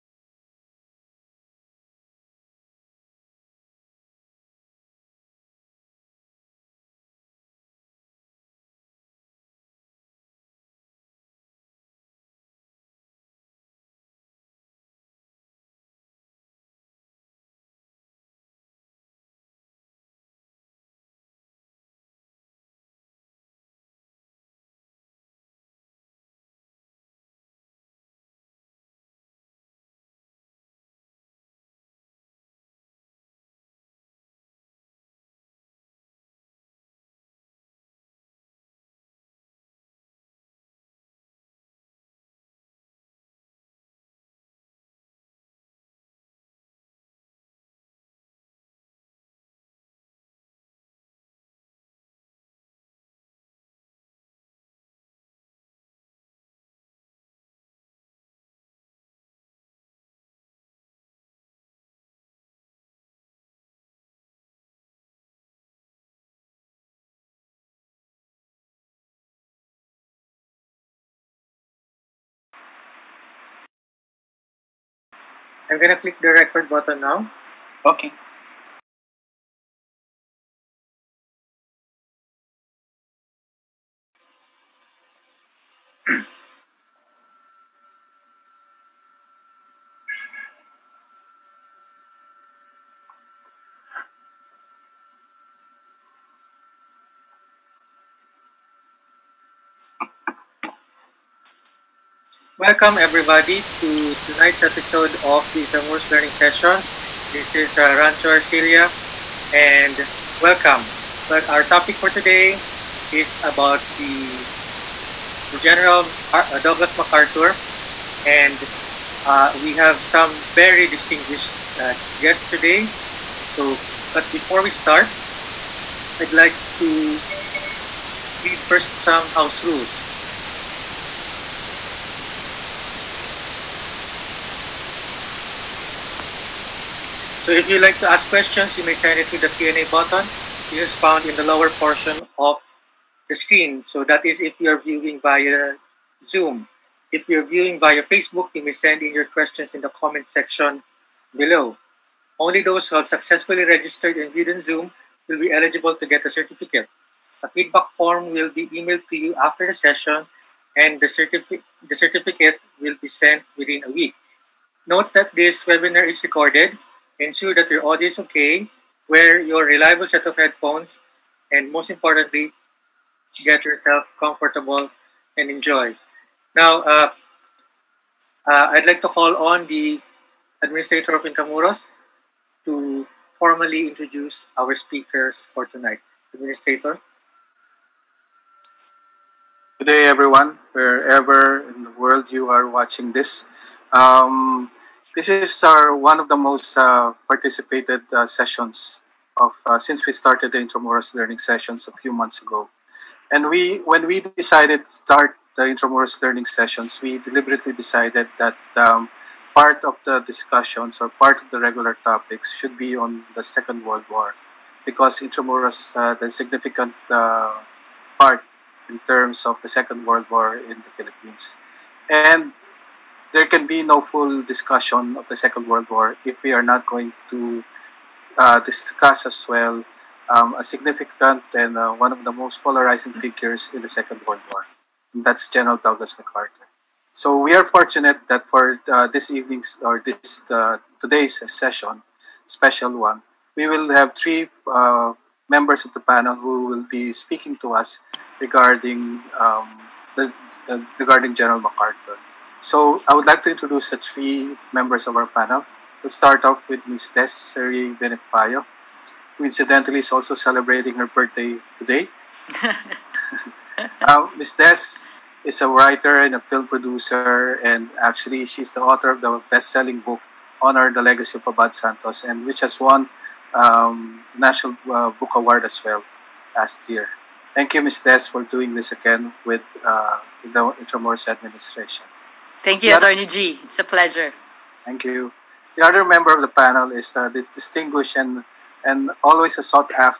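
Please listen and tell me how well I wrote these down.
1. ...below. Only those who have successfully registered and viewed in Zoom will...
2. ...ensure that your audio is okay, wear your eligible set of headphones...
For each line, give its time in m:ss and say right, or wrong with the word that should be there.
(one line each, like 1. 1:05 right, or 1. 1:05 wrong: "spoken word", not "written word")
1. 2:31 right
2. 2:47 wrong: "reliable", not "eligible".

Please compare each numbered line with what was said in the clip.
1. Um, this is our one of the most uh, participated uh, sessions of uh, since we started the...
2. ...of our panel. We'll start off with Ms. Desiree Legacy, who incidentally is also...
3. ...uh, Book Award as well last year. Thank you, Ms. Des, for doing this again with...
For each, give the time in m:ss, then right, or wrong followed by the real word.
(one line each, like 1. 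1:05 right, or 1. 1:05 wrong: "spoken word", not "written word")
1. 3:13 right
2. 4:15 wrong: "Benipayo", not "Legacy"
3. 4:34 right.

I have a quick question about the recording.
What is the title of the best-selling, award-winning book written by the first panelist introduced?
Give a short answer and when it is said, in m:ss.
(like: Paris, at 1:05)
Honor the Legacy of Abad Santos, at 4:30.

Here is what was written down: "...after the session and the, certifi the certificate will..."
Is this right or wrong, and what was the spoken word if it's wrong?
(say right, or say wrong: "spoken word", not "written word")
right.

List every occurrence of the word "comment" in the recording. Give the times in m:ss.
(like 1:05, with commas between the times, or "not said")
2:29.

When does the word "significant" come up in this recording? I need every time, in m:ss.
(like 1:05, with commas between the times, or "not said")
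3:36, 3:50.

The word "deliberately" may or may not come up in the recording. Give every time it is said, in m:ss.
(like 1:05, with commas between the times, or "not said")
3:27.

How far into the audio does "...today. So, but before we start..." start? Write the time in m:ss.
2:02.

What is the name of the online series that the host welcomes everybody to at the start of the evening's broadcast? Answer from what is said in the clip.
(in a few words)
Intramuros Learning Session.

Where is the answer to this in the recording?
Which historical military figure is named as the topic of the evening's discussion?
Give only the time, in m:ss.
1:55.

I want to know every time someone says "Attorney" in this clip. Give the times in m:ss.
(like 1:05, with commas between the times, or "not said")
4:42.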